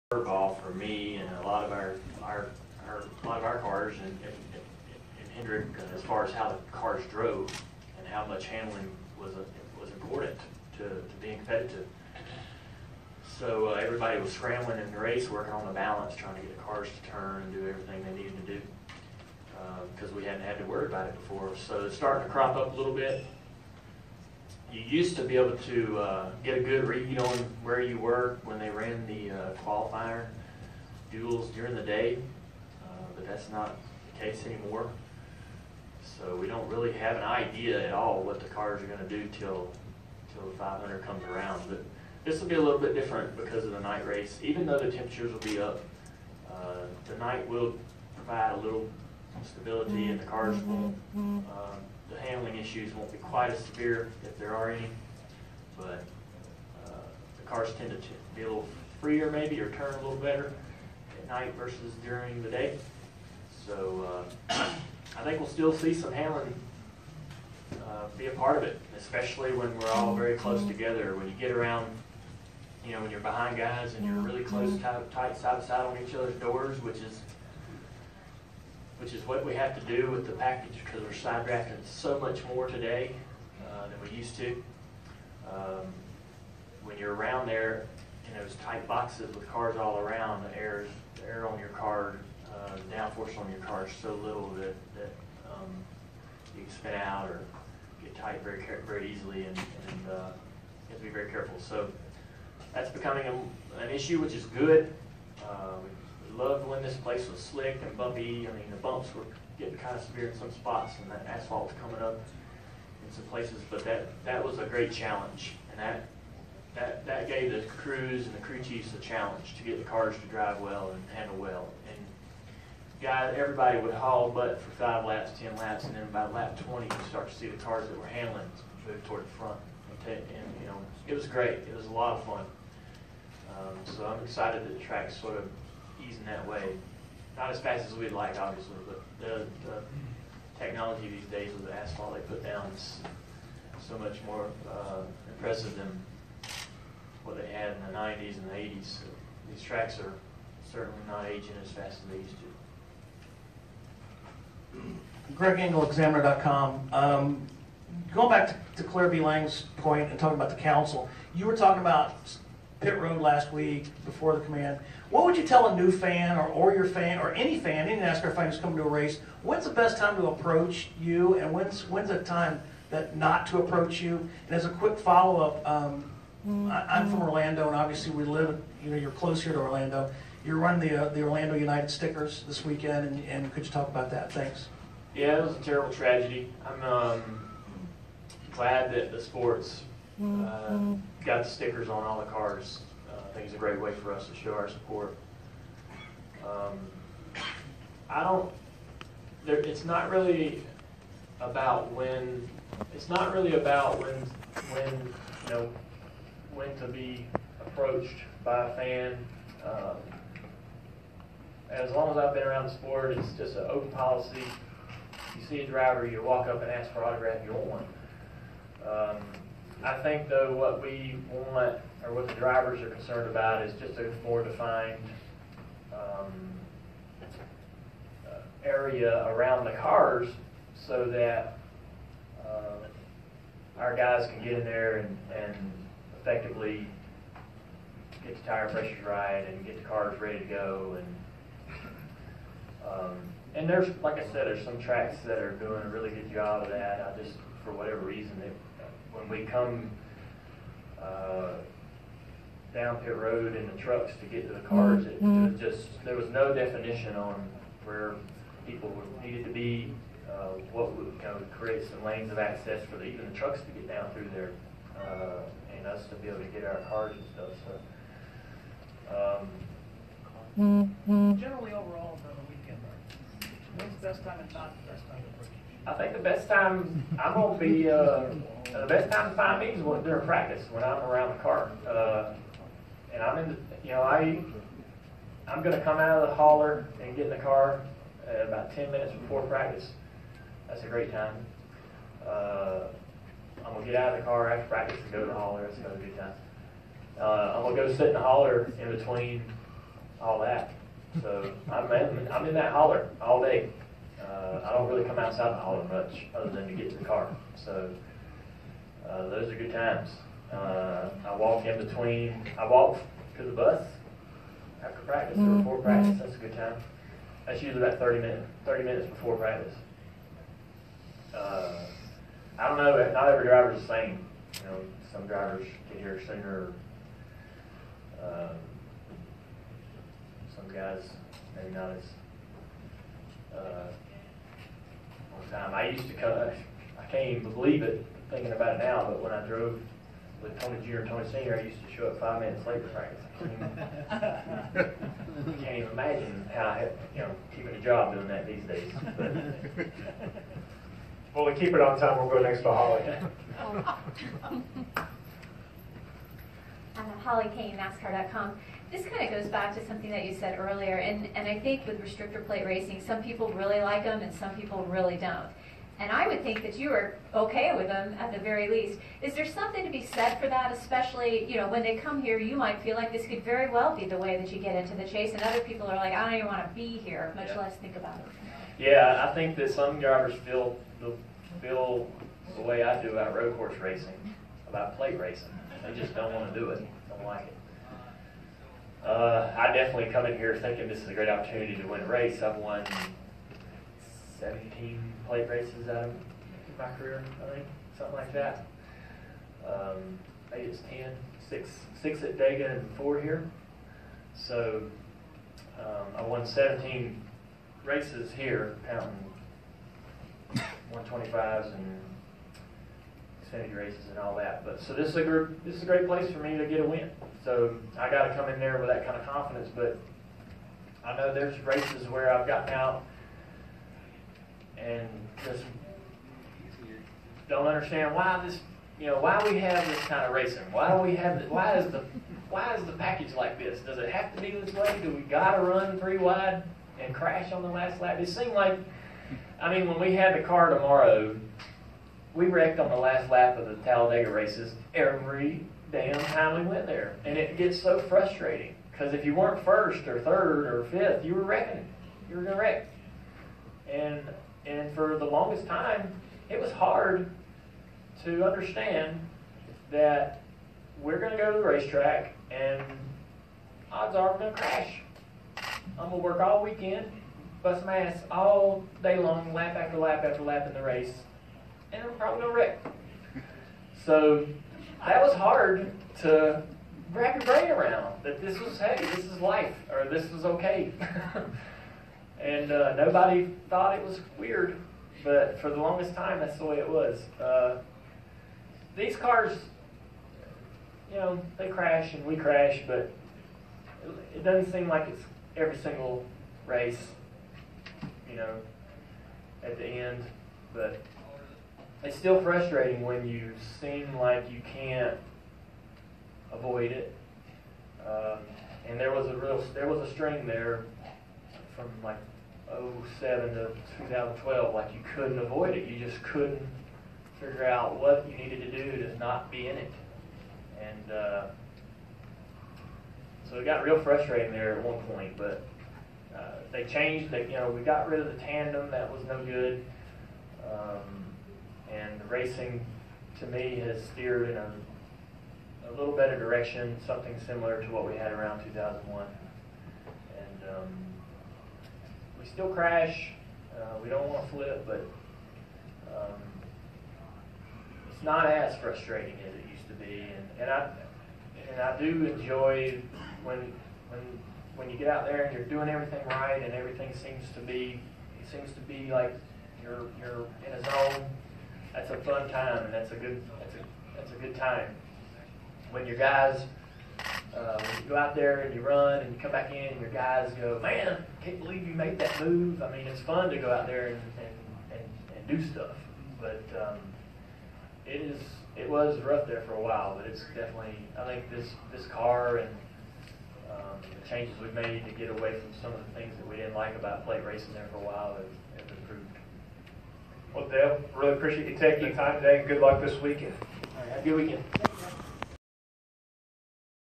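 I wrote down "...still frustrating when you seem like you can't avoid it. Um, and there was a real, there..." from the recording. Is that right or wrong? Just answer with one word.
right.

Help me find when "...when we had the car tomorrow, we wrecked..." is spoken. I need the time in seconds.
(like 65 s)
439 s.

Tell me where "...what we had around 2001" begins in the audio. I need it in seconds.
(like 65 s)
537 s.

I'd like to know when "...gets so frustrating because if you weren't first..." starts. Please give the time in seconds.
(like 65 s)
447 s.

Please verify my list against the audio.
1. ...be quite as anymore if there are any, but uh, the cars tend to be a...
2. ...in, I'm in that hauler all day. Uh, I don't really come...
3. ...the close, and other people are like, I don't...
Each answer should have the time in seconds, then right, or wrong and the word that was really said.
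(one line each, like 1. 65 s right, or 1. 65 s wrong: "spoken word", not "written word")
1. 53 s wrong: "severe", not "anymore"
2. 301 s right
3. 374 s wrong: "chase", not "close".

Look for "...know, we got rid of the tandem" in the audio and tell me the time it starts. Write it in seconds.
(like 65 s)
527 s.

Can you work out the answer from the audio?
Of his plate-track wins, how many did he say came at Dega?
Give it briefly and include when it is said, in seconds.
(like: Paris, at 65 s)
6, at 402 s.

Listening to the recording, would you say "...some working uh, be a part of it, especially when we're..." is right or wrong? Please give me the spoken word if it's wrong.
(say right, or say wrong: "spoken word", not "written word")
wrong: "handling", not "working".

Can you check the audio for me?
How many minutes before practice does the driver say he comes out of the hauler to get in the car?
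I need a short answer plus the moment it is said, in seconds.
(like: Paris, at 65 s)
10, at 288 s.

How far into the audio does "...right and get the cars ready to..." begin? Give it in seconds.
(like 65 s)
239 s.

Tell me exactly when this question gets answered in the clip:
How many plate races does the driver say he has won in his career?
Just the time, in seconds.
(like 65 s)
394 s.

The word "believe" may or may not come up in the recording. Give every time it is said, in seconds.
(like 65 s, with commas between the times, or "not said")
337 s, 571 s.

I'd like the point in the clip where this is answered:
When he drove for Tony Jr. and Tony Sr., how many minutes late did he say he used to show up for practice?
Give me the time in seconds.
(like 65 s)
342 s.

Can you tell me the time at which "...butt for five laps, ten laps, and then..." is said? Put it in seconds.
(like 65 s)
124 s.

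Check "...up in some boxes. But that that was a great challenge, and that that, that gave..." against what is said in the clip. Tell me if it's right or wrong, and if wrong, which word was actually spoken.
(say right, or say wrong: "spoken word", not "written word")
wrong: "places", not "boxes".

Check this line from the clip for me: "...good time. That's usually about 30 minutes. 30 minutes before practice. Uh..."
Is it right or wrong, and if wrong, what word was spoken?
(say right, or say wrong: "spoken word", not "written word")
right.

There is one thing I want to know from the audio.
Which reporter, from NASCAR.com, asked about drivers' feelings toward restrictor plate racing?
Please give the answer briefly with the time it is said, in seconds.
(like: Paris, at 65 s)
Holly Cain, at 357 s.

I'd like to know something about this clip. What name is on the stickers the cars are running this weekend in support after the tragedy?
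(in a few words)
Orlando United.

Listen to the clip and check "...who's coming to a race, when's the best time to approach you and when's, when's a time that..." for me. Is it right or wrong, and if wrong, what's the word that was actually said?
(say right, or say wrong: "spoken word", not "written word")
right.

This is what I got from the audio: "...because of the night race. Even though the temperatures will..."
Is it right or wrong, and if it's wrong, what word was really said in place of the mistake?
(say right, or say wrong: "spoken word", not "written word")
right.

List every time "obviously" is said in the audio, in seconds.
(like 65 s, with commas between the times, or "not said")
138 s, 177 s.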